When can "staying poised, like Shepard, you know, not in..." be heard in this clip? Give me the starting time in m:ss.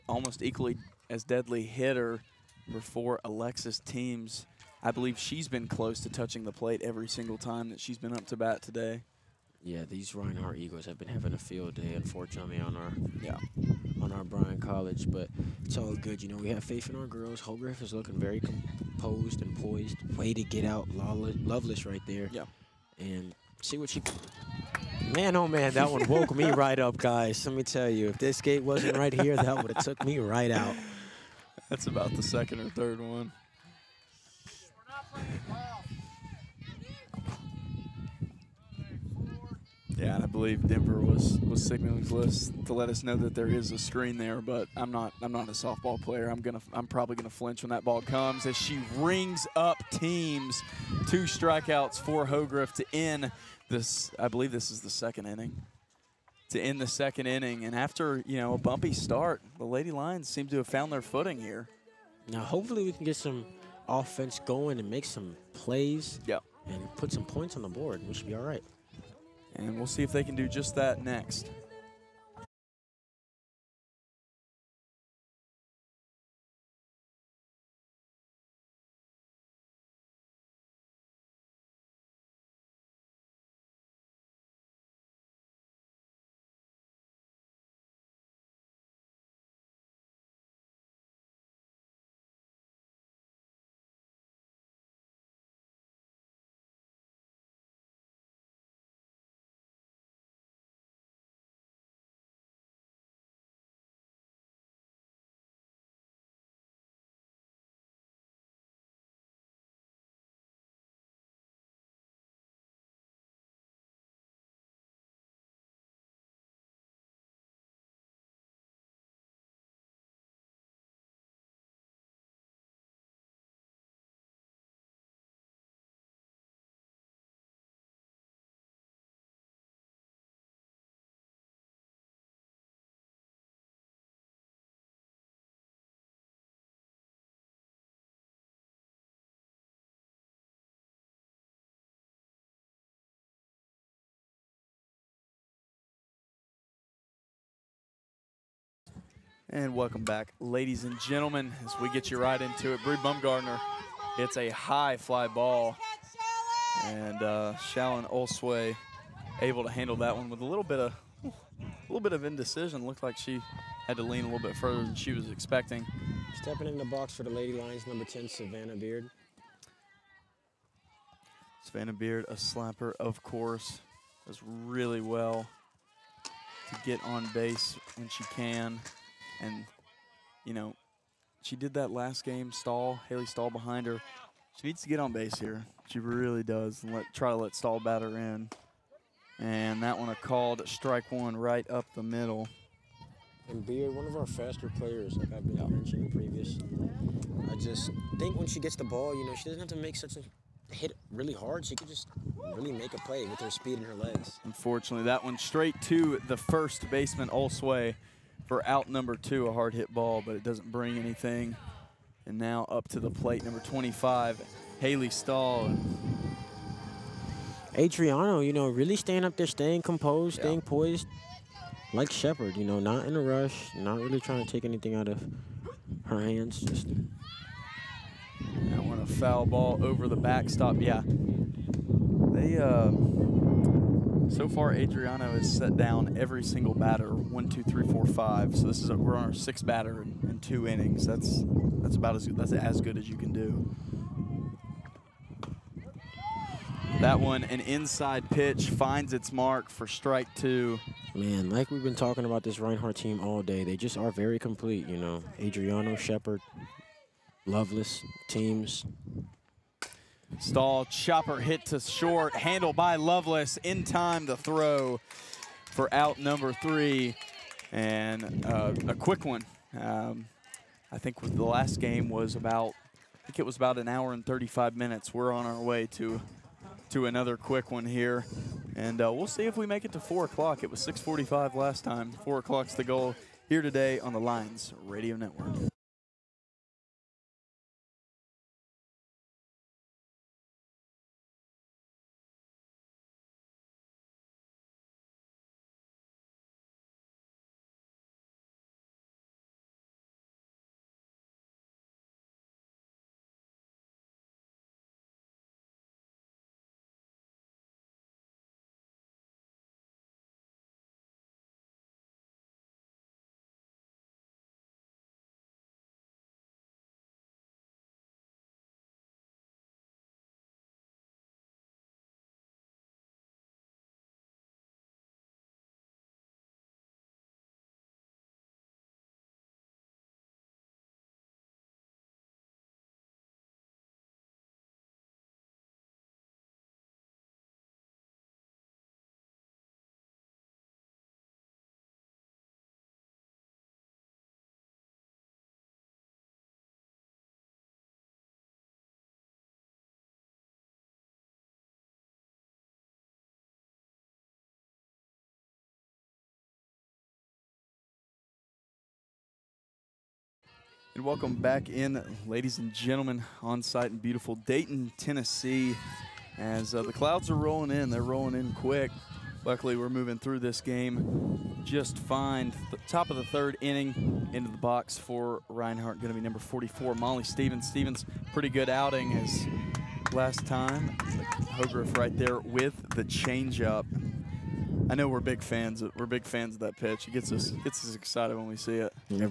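3:40.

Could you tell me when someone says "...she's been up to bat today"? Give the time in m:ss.
0:07.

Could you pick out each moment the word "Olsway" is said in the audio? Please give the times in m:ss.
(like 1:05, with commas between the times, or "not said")
2:38, 3:27.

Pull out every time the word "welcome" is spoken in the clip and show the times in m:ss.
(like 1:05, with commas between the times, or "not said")
2:29, 6:01.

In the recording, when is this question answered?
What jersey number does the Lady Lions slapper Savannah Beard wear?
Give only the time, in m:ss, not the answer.
2:47.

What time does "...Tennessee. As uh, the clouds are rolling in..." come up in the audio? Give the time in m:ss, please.
6:04.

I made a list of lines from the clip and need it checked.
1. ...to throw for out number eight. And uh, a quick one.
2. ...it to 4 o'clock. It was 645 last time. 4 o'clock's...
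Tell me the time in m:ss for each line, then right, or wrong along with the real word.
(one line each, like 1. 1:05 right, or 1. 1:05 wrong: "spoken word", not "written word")
1. 4:24 wrong: "three", not "eight"
2. 4:39 right.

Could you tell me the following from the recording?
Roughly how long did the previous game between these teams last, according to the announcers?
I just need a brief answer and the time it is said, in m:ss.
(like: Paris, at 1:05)
1 hour 35 minutes, at 4:33.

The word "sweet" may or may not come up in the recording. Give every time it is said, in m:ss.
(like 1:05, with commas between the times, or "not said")
not said.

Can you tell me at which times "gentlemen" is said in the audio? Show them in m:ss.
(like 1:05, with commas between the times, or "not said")
2:30, 6:02.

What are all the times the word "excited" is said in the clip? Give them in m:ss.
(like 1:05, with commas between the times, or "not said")
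6:27.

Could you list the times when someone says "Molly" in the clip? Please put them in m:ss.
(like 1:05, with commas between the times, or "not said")
6:16.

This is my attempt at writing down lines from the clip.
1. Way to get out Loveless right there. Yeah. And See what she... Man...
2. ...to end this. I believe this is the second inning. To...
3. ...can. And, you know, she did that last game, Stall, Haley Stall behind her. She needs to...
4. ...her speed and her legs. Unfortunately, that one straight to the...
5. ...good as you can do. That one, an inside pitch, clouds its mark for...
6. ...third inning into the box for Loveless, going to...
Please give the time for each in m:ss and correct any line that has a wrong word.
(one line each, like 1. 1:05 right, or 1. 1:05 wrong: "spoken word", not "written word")
1. 0:20 right
2. 0:52 right
3. 2:58 right
4. 3:23 right
5. 4:02 wrong: "finds", not "clouds"
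6. 6:13 wrong: "Reinhardt", not "Loveless".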